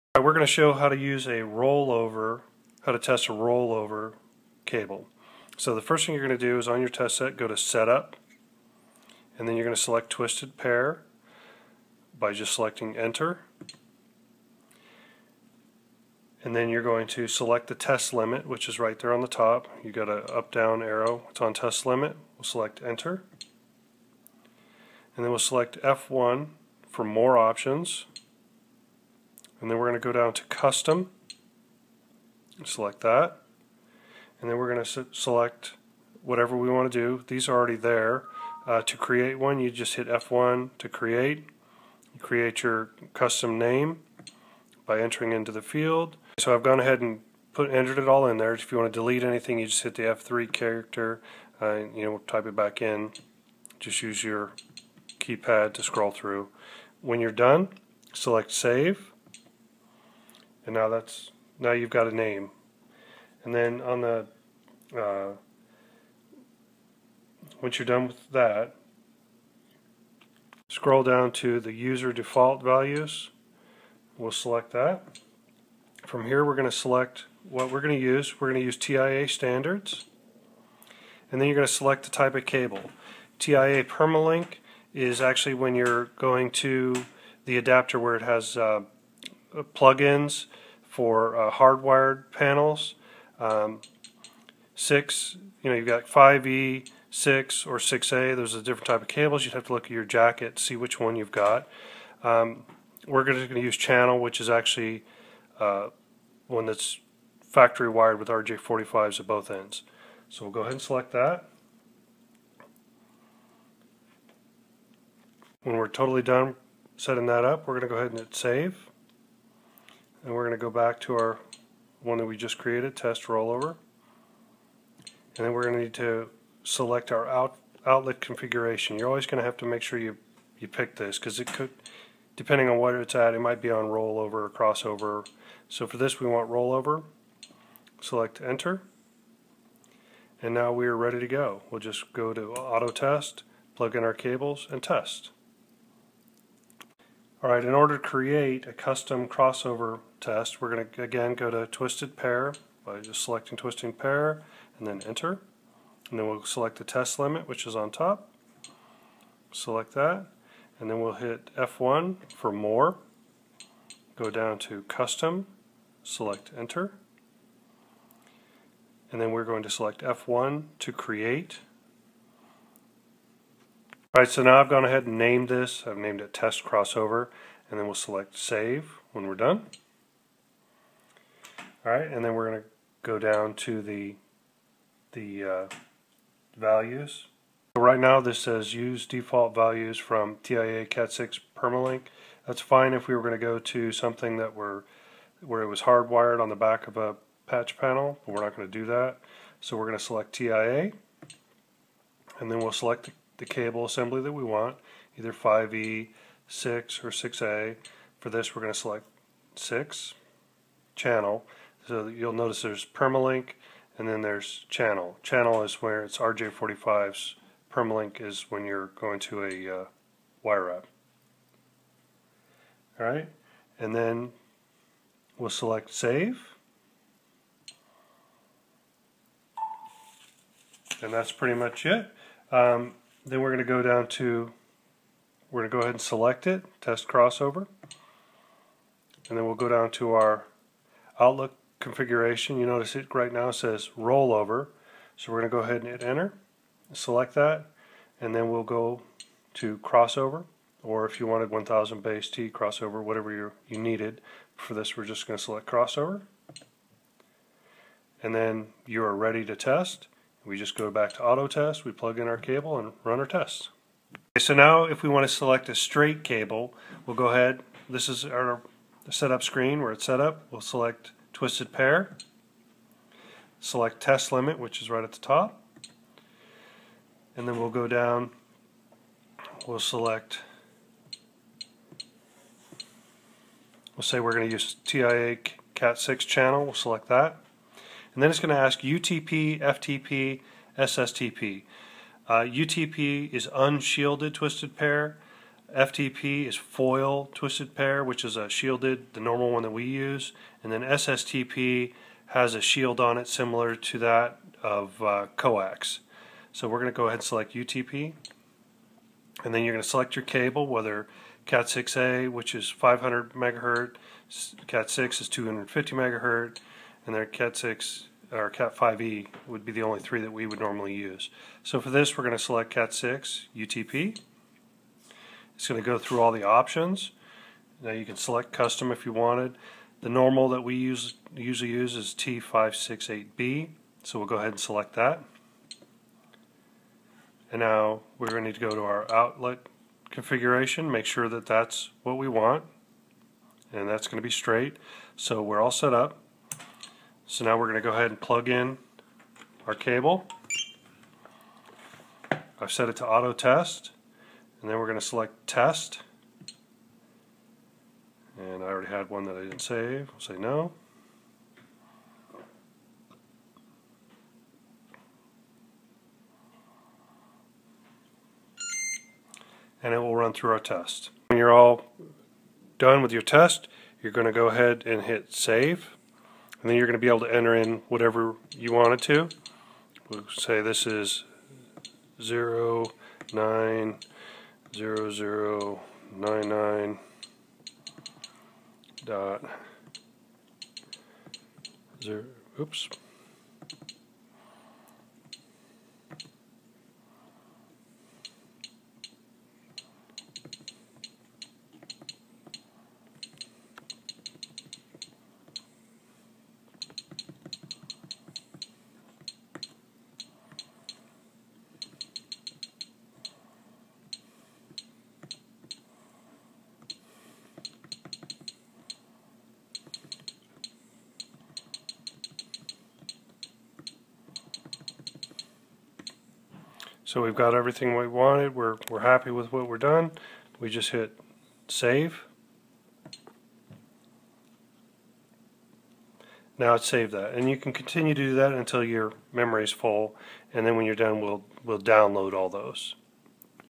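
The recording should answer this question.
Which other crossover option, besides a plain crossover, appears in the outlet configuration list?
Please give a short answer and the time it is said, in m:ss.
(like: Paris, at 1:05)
1000 base T crossover, at 4:11.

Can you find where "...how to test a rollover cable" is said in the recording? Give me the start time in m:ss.
0:02.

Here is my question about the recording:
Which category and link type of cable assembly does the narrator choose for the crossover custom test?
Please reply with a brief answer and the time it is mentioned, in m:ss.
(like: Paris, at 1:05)
6 channel, at 3:29.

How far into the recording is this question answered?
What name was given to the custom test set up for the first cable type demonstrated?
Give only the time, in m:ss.
2:02.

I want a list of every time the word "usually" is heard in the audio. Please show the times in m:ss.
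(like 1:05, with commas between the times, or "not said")
5:31.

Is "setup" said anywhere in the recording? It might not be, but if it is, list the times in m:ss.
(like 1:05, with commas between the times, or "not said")
0:07, 4:29.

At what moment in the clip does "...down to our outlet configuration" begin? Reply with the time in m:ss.
3:59.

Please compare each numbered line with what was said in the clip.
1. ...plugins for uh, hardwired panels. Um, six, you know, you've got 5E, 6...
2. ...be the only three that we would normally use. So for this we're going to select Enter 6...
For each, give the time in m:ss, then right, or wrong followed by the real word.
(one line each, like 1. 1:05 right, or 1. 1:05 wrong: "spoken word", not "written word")
1. 1:29 right
2. 5:19 wrong: "Cat", not "Enter".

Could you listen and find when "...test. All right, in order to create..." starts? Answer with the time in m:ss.
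2:24.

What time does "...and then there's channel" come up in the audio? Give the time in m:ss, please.
3:33.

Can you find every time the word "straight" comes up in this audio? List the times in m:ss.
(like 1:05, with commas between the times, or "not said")
4:25, 5:44.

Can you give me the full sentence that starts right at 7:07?
So we've got everything we wanted.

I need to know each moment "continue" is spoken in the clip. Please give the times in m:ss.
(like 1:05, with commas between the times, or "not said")
7:17.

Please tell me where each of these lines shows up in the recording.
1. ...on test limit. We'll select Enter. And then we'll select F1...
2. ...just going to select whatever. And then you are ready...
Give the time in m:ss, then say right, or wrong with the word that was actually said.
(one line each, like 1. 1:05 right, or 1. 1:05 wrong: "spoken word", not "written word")
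1. 0:21 right
2. 4:15 wrong: "crossover", not "whatever".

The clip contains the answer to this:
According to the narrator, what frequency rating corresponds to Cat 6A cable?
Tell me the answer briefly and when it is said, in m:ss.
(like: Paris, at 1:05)
500 megahertz, at 5:12.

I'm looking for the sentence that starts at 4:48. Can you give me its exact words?
And then it's going to ask UTP, FTP, SSTP.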